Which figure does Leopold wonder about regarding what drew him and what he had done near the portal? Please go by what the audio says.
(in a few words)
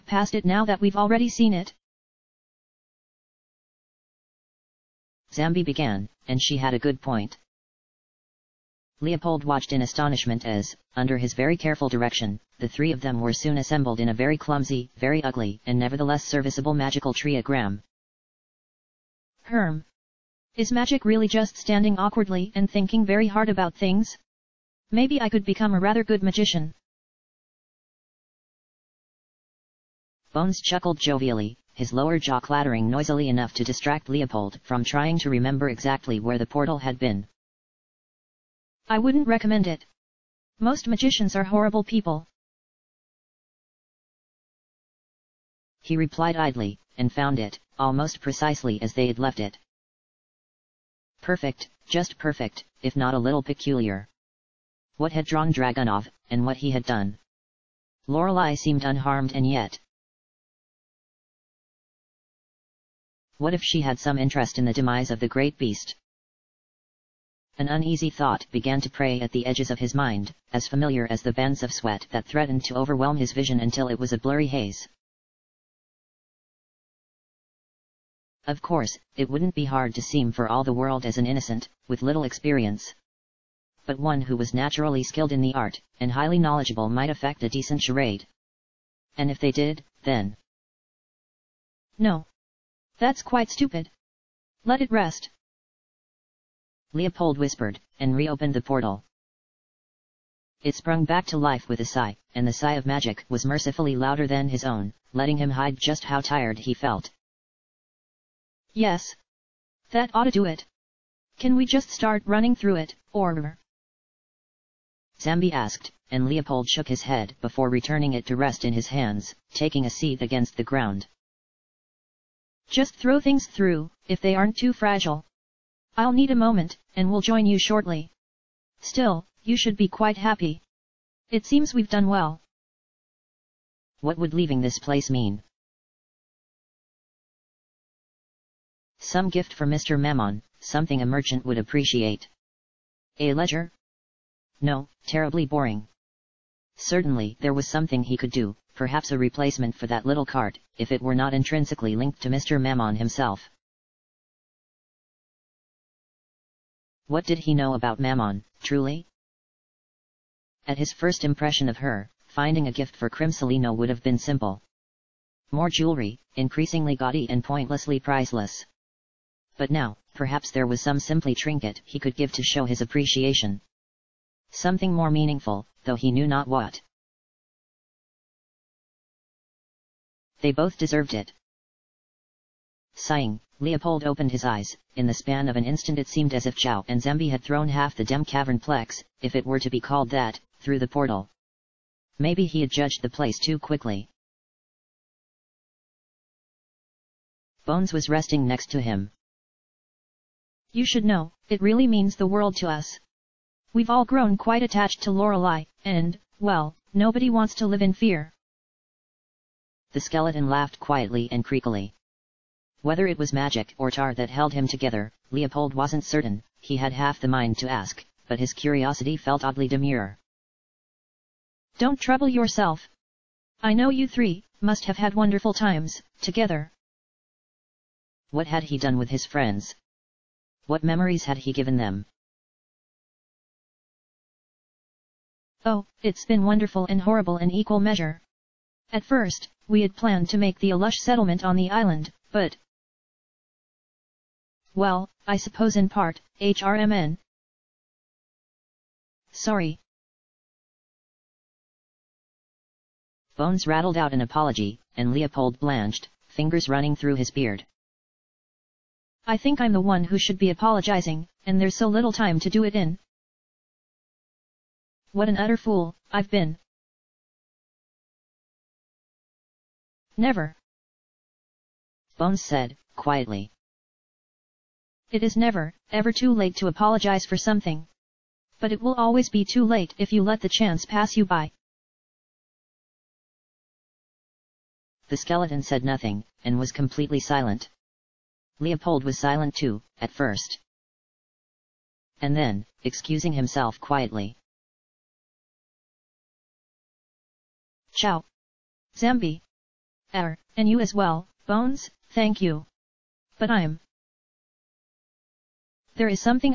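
Dragunov.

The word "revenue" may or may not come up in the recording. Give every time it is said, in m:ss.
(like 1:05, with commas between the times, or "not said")
not said.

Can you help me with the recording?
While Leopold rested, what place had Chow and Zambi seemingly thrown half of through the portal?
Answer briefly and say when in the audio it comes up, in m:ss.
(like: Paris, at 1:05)
Dem Cavern Plex, at 3:08.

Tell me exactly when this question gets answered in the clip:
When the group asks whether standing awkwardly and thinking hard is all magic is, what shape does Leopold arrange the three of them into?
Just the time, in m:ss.
0:16.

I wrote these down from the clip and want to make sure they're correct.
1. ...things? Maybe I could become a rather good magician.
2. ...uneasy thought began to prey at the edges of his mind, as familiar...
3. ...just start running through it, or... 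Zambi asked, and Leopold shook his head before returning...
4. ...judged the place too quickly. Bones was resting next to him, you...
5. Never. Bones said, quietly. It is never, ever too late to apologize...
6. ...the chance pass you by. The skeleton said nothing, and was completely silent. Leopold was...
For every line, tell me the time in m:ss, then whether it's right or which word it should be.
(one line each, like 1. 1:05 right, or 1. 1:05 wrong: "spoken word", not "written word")
1. 0:23 right
2. 1:07 right
3. 1:51 right
4. 3:12 right
5. 4:30 right
6. 4:40 right.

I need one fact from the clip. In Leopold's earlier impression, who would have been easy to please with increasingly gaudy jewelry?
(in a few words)
Crimsolino.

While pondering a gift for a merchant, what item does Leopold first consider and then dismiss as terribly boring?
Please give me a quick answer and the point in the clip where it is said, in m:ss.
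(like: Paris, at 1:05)
A ledger, at 2:23.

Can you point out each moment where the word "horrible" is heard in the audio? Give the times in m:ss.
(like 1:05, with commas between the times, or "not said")
0:41, 3:57.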